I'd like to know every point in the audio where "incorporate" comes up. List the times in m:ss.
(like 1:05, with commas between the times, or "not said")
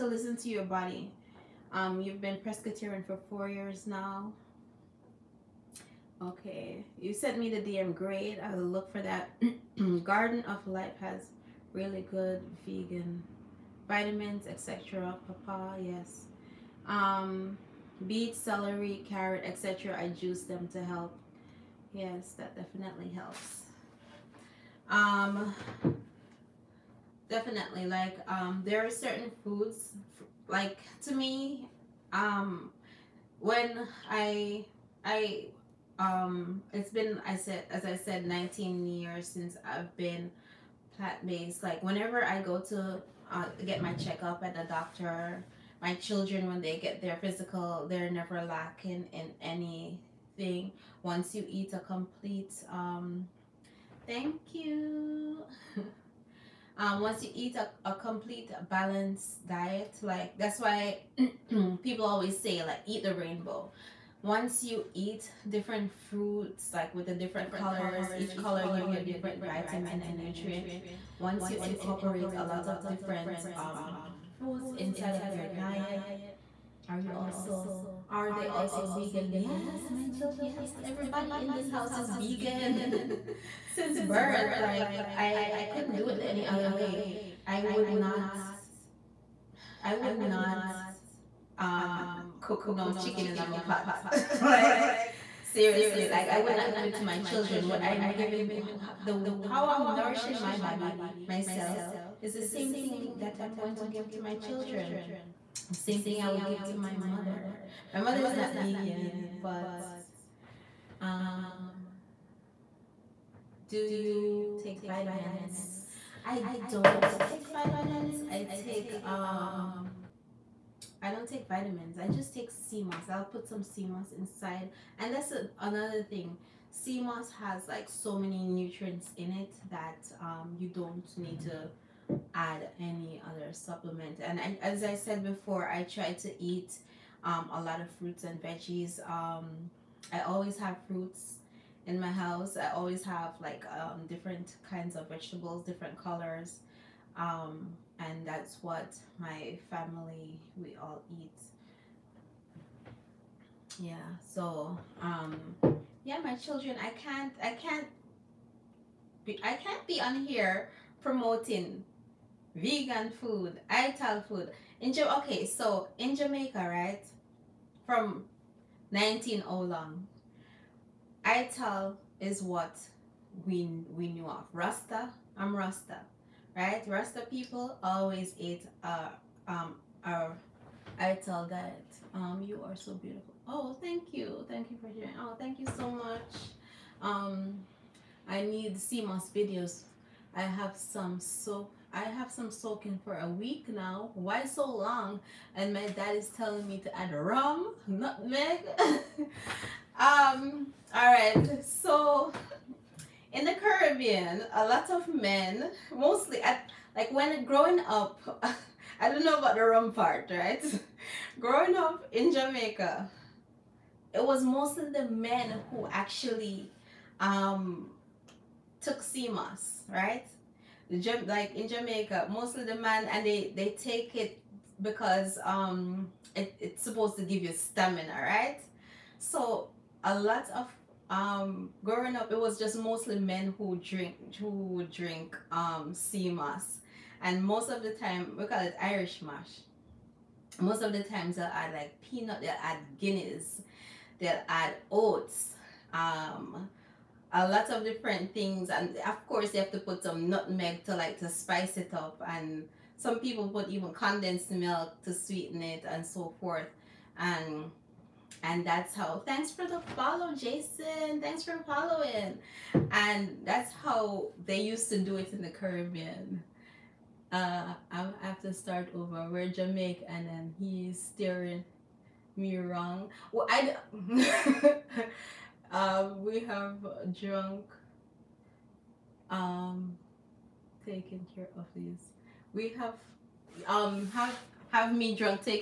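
1:11.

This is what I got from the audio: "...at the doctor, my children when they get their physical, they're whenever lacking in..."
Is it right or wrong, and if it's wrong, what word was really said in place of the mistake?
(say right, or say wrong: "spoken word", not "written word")
wrong: "never", not "whenever".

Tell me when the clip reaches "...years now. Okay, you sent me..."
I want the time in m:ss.
0:03.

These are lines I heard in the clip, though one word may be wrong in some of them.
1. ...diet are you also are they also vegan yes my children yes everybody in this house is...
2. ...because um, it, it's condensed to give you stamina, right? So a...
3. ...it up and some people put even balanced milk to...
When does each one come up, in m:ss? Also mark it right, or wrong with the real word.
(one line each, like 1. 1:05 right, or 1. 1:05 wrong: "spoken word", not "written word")
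1. 1:15 right
2. 3:44 wrong: "supposed", not "condensed"
3. 4:11 wrong: "condensed", not "balanced".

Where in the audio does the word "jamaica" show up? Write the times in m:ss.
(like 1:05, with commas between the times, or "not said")
2:46, 3:32, 3:41, 4:29.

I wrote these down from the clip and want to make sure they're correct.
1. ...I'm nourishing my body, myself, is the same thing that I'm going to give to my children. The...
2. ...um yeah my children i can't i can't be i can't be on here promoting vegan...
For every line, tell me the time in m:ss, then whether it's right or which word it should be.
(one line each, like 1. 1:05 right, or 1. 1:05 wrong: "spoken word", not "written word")
1. 1:39 right
2. 2:35 right.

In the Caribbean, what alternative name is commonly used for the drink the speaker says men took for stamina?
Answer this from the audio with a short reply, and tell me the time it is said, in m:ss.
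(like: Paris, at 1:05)
Irish moss, at 3:58.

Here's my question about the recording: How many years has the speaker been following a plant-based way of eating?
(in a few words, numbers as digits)
19.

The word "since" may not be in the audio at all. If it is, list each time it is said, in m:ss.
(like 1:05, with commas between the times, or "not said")
0:39, 1:23.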